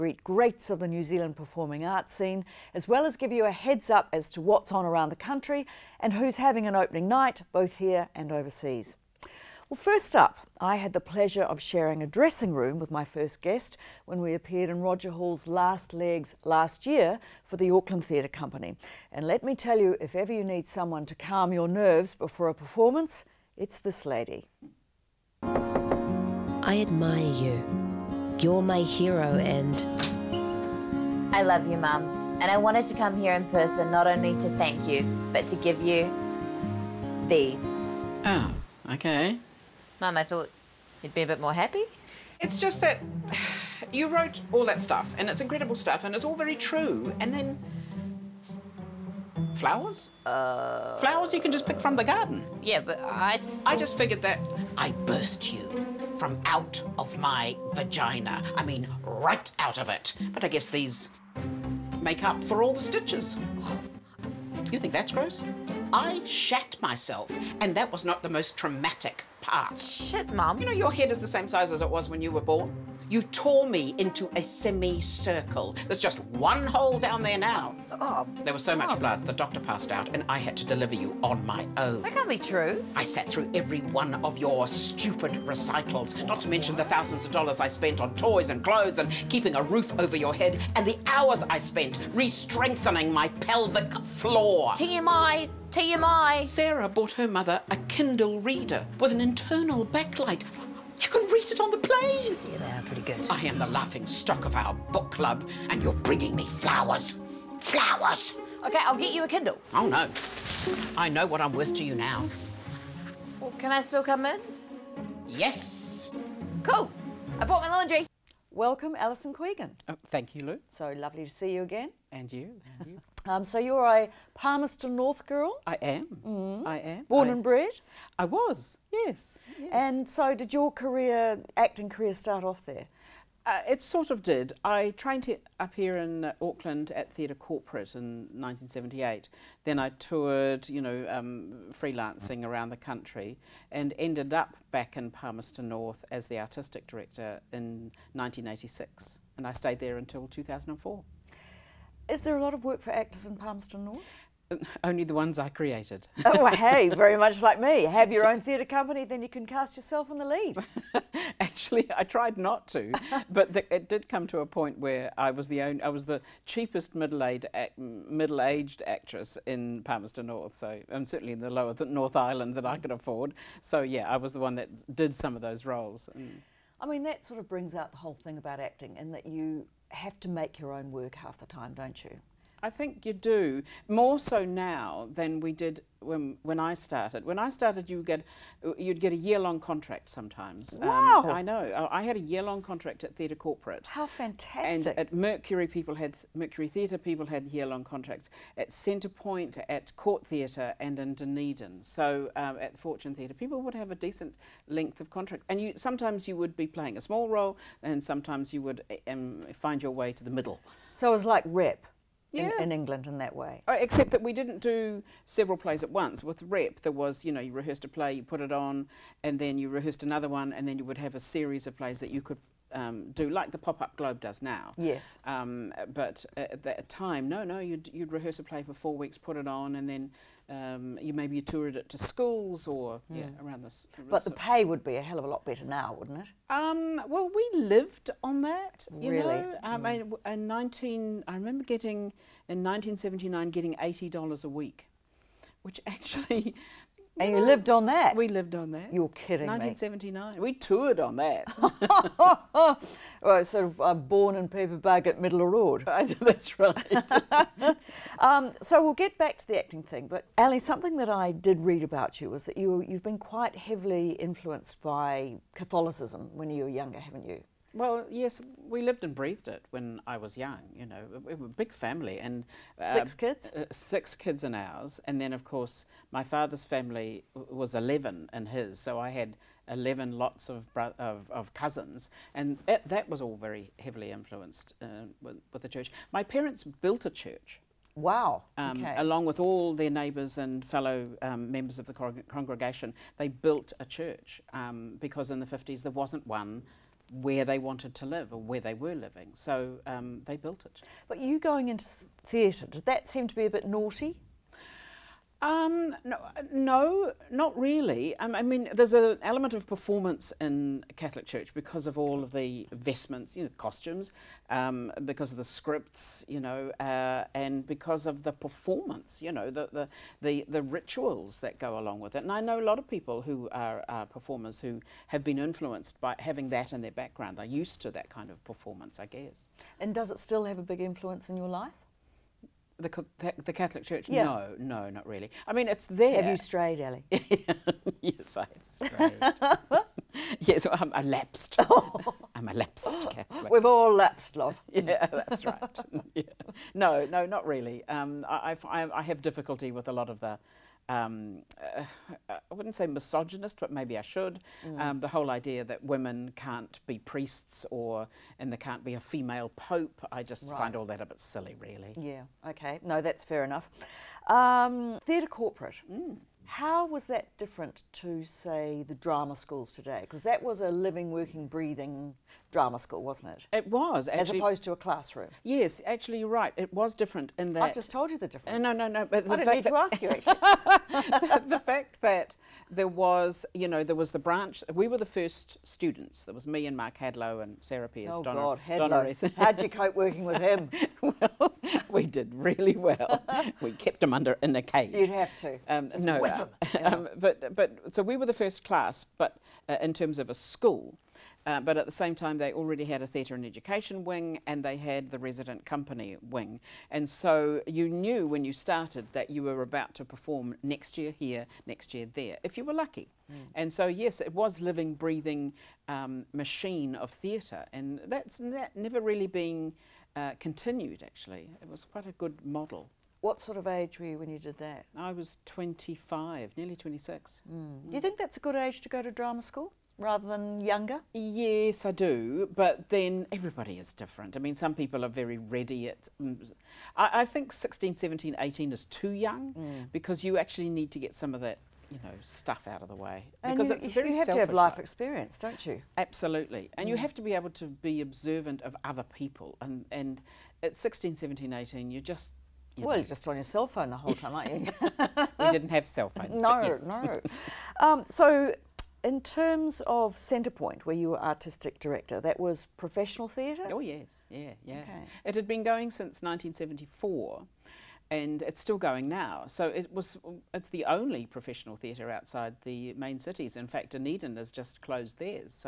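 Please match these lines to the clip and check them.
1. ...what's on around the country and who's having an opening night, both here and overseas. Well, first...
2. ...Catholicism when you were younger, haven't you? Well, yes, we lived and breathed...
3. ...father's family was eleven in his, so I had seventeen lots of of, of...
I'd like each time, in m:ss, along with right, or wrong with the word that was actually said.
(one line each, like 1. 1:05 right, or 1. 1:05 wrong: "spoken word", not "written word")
1. 0:04 right
2. 4:25 right
3. 4:36 wrong: "eleven", not "seventeen".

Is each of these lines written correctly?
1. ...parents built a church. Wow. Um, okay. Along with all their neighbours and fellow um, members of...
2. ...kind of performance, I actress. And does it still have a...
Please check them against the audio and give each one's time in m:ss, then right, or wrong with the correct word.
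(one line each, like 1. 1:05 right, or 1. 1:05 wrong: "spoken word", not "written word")
1. 4:46 right
2. 5:28 wrong: "guess", not "actress".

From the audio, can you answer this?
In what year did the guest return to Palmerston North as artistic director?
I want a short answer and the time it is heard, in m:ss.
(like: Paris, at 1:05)
1986, at 2:28.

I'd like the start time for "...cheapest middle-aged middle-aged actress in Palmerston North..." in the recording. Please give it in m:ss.
2:46.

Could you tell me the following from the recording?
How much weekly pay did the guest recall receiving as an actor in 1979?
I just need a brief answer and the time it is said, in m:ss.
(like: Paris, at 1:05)
$80, at 4:03.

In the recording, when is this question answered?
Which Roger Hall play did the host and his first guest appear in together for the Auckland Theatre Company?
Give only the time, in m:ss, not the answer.
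0:15.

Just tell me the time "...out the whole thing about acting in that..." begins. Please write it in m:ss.
2:57.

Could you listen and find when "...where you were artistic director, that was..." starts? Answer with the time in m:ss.
7:40.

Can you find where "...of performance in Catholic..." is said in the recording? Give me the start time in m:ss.
5:09.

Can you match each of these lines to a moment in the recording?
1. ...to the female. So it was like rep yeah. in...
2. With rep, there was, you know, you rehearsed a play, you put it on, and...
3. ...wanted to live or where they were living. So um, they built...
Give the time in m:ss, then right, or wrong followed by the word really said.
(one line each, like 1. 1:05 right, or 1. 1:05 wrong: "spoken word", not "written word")
1. 3:30 wrong: "middle", not "female"
2. 3:36 right
3. 4:57 right.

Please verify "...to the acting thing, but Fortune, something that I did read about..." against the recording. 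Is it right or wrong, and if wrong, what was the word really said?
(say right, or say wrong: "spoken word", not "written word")
wrong: "Ali", not "Fortune".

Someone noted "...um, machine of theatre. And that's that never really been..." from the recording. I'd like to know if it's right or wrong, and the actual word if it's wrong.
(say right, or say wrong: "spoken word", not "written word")
right.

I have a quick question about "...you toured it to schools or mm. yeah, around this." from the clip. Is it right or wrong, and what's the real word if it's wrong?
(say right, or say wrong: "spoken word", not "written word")
right.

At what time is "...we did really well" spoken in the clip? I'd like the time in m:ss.
6:31.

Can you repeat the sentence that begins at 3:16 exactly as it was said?
People had year long contracts at Centrepoint, at Court Theatre, and in Dunedin.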